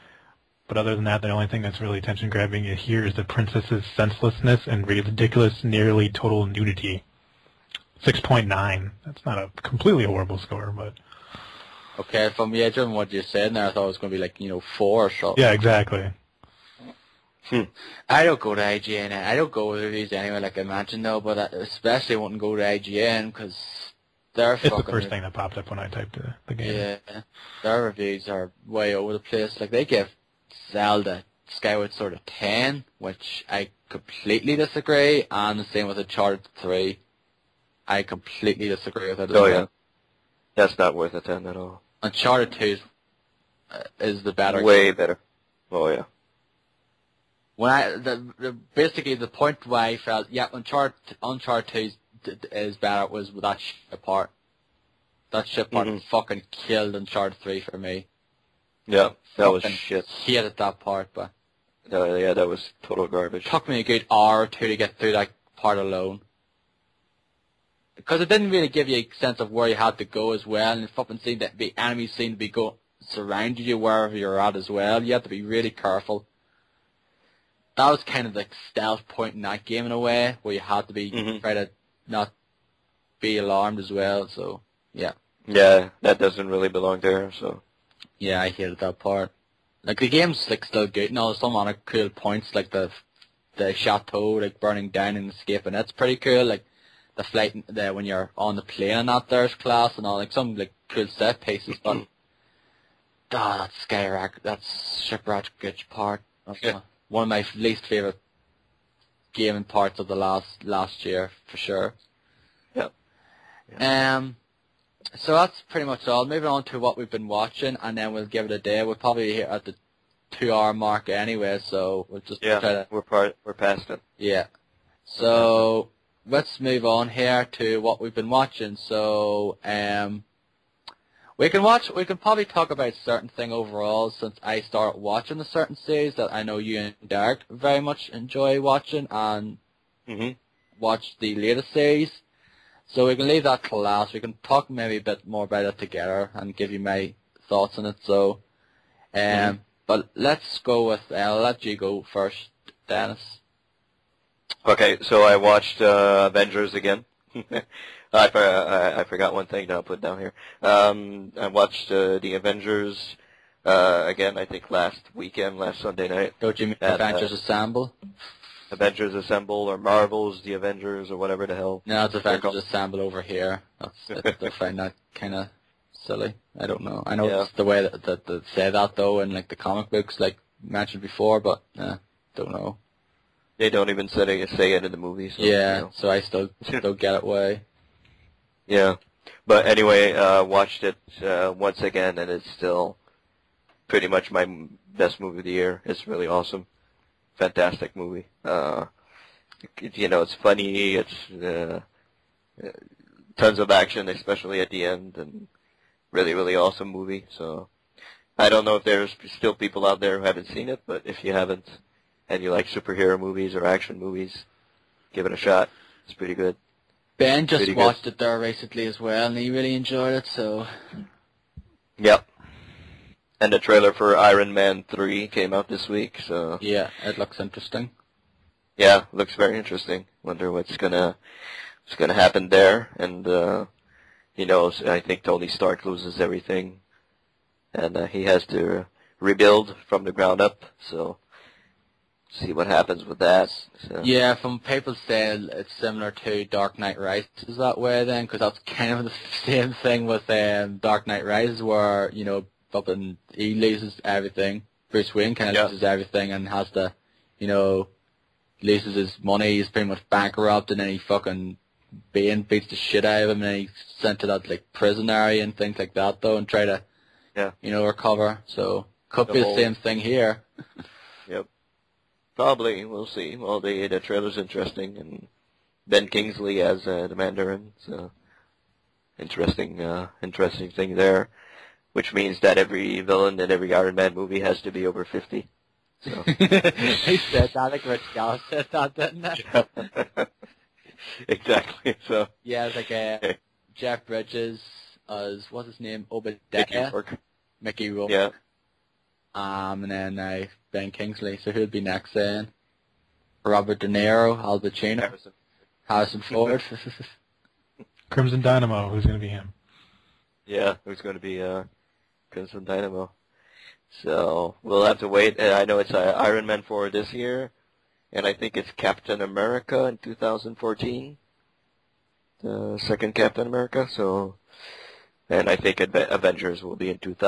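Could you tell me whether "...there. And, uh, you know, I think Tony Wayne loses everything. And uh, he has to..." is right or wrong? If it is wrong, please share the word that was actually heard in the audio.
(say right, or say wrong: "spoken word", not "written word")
wrong: "Stark", not "Wayne".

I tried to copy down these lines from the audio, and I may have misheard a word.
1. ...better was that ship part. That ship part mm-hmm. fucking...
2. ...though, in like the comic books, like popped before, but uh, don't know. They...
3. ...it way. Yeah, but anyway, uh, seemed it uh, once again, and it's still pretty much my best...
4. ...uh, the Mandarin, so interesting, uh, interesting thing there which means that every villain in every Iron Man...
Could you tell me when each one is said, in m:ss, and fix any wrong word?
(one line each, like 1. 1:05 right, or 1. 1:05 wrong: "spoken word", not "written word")
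1. 0:52 right
2. 2:58 wrong: "mentioned", not "popped"
3. 3:07 wrong: "watched", not "seemed"
4. 4:36 right.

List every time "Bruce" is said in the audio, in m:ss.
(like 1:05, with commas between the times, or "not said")
4:14.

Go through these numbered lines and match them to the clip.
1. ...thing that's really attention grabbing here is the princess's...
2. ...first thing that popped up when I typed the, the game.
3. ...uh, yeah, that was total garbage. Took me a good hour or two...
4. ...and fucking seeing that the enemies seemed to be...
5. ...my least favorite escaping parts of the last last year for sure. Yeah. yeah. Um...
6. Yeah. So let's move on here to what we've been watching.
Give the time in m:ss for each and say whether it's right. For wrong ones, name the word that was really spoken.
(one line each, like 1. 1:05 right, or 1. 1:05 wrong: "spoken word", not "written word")
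1. 0:01 right
2. 0:24 right
3. 1:02 right
4. 1:10 right
5. 1:47 wrong: "gaming", not "escaping"
6. 2:04 right.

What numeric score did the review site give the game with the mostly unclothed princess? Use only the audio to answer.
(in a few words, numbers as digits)
6.9.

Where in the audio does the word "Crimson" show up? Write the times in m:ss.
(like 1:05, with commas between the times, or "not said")
5:08, 5:12.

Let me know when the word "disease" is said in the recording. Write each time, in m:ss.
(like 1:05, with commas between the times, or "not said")
not said.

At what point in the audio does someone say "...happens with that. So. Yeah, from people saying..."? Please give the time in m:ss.
4:02.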